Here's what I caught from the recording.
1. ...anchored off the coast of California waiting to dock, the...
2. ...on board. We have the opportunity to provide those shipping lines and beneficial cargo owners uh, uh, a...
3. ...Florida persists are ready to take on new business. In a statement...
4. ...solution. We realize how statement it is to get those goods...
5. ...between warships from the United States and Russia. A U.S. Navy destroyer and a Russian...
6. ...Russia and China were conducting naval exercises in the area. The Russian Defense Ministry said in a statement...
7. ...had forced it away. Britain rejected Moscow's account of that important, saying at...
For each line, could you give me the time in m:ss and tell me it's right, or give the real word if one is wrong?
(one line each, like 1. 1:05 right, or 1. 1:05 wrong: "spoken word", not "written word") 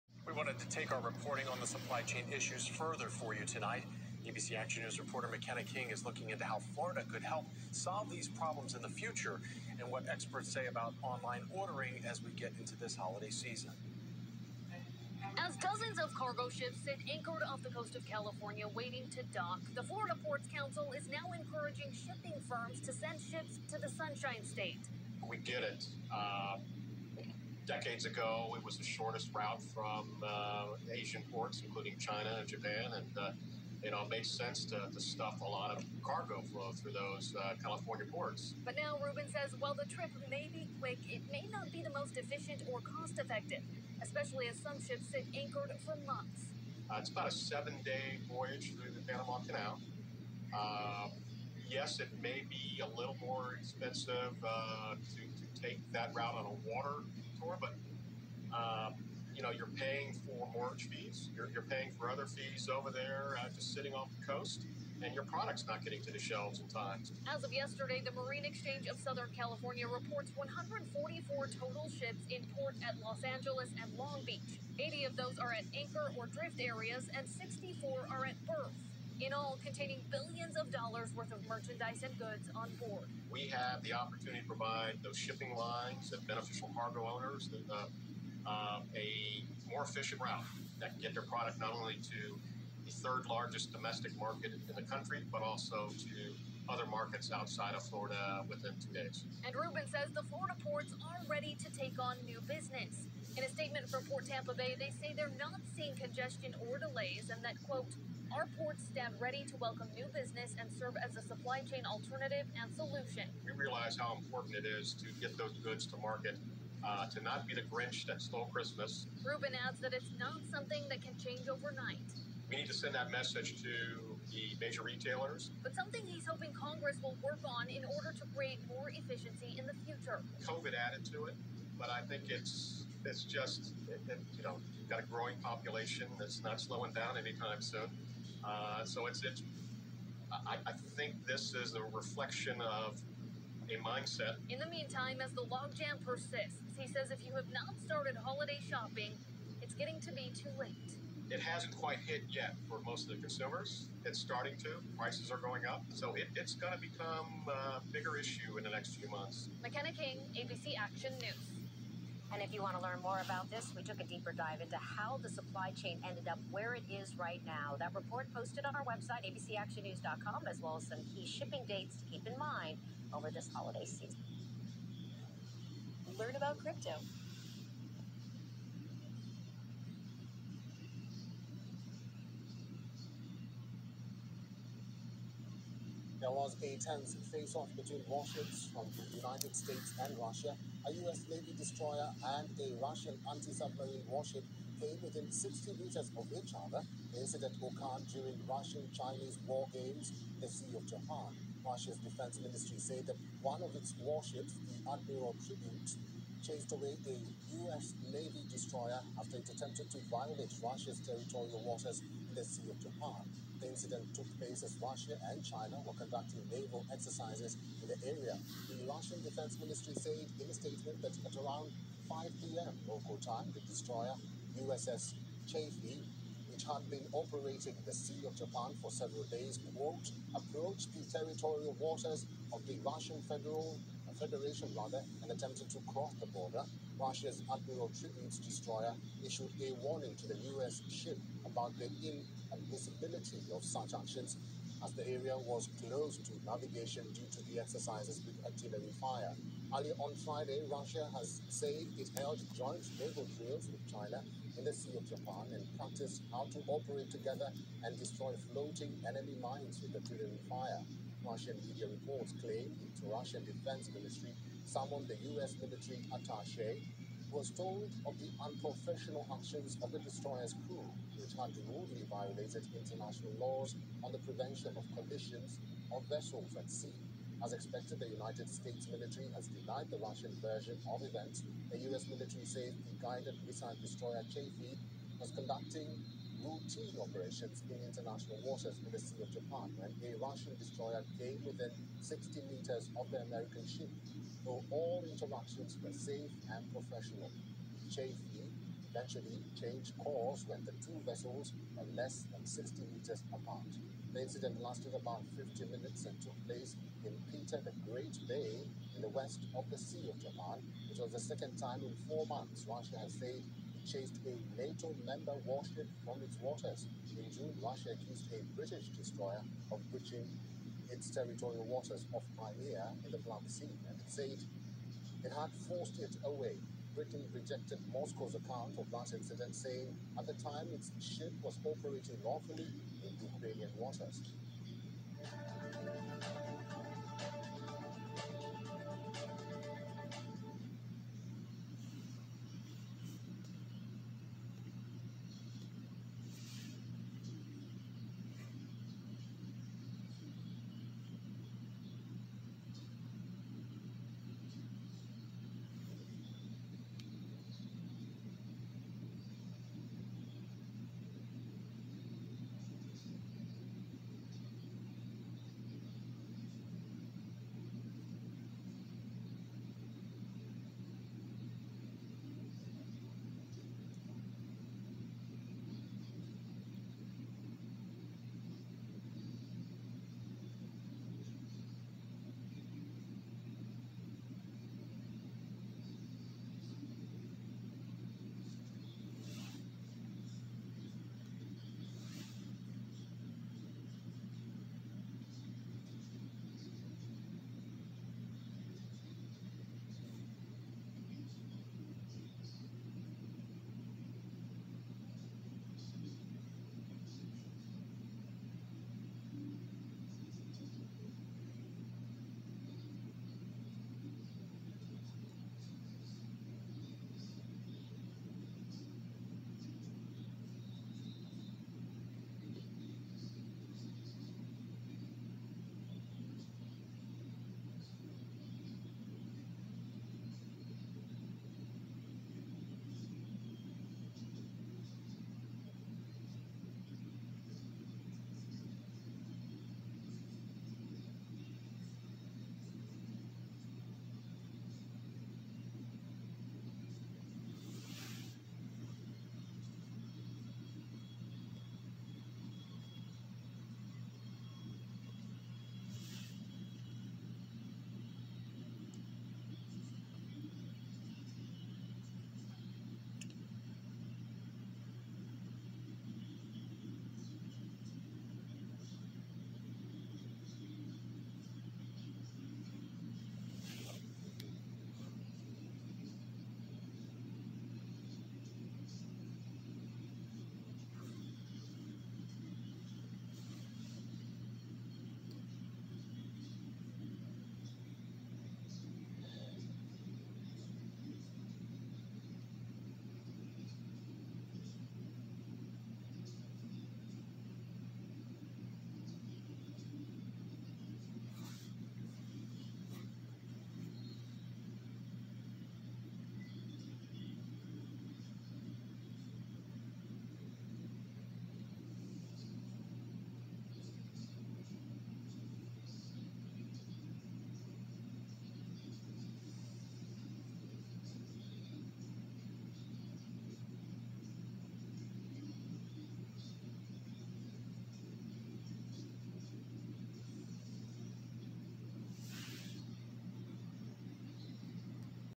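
1. 0:17 right
2. 1:22 right
3. 1:40 wrong: "ports", not "persists"
4. 1:52 wrong: "important", not "statement"
5. 3:07 right
6. 3:34 right
7. 5:25 wrong: "incident", not "important".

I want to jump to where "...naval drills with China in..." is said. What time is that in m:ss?
4:12.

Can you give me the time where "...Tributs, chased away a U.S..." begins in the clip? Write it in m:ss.
3:25.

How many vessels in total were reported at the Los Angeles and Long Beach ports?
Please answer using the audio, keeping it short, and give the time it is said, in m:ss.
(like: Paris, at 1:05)
144, at 1:10.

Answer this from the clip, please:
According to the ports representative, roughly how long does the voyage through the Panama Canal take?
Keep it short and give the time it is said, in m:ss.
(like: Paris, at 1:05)
7 days, at 0:47.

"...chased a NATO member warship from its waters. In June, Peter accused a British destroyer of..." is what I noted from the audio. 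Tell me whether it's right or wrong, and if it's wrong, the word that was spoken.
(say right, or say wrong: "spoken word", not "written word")
wrong: "Russia", not "Peter".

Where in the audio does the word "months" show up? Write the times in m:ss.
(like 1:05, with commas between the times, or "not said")
0:46, 2:39, 5:12.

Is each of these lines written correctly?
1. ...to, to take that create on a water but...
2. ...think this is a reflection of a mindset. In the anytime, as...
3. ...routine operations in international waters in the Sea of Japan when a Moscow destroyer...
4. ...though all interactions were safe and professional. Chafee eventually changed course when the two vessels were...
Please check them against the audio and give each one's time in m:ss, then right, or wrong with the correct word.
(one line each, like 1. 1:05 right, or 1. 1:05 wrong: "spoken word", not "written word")
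1. 0:54 wrong: "route", not "create"
2. 2:20 wrong: "meantime", not "anytime"
3. 4:46 wrong: "Russian", not "Moscow"
4. 4:54 right.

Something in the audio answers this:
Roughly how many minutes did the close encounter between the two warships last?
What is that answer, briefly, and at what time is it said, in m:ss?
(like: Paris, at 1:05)
50 minutes, at 5:05.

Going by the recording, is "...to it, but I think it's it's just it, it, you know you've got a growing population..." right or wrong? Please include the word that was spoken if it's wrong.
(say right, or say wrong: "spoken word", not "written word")
right.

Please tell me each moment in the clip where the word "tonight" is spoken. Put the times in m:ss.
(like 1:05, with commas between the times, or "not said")
0:03.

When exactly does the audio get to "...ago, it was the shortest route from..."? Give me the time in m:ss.
0:28.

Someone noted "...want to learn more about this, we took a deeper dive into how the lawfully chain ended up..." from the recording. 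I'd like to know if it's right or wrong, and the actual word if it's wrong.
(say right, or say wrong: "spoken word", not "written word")
wrong: "supply", not "lawfully".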